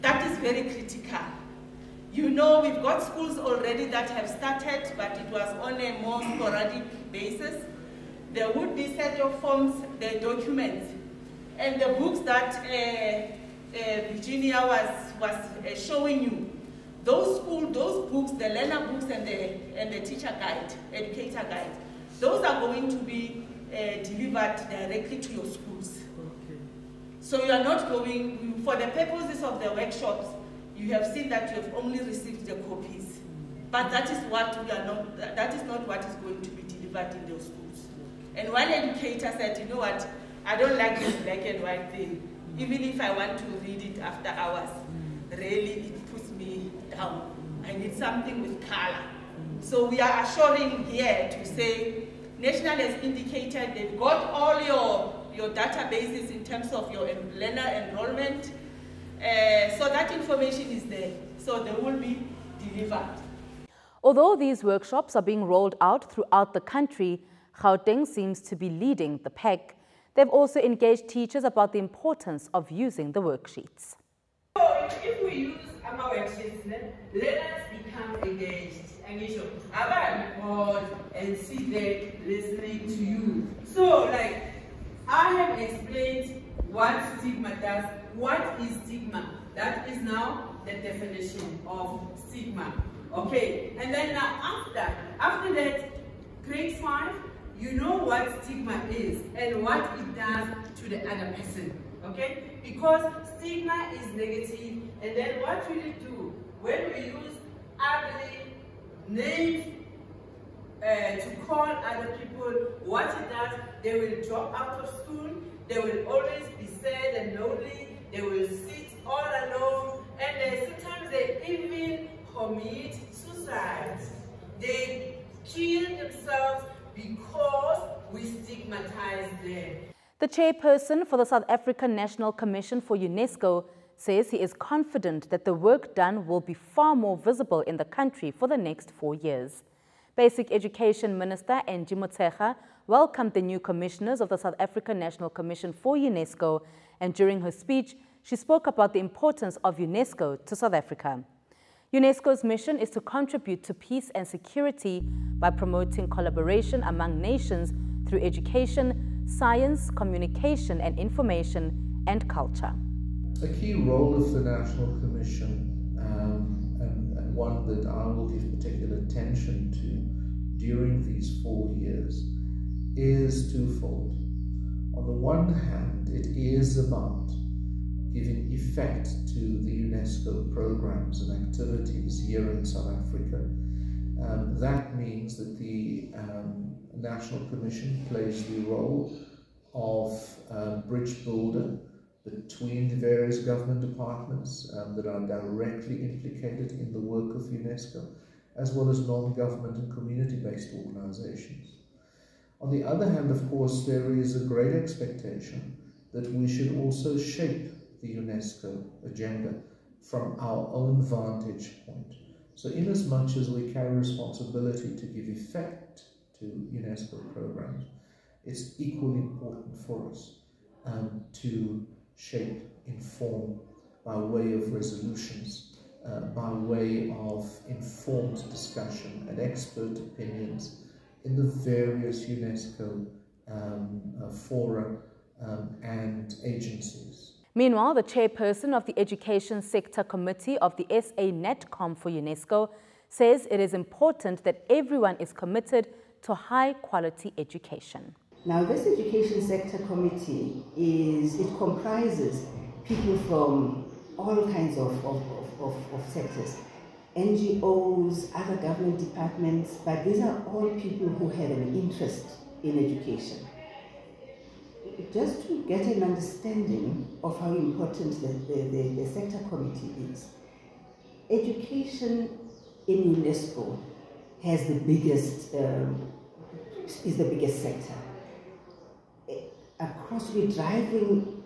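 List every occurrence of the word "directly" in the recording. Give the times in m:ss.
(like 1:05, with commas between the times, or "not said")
0:24, 3:15.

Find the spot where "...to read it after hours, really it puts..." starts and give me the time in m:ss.
0:43.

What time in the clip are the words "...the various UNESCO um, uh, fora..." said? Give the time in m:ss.
3:51.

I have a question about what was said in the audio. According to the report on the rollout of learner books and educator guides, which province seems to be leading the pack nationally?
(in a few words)
Gauteng.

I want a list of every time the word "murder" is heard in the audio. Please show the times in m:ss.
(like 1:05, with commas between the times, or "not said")
not said.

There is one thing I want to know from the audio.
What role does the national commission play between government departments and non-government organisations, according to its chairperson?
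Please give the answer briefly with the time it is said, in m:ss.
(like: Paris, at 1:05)
bridge builder, at 3:10.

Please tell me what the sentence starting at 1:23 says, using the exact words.
So like, I have explained what stigma does, what is stigma.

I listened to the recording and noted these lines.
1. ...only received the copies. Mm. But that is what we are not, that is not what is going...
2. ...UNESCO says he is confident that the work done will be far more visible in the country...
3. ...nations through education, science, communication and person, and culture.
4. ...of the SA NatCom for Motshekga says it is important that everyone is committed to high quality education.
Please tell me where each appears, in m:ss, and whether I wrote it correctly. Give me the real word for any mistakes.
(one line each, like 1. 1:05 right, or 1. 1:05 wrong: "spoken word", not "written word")
1. 0:31 right
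2. 2:12 right
3. 2:37 wrong: "information", not "person"
4. 4:00 wrong: "UNESCO", not "Motshekga".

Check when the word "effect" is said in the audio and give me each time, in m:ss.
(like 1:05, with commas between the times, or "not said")
2:58, 3:35.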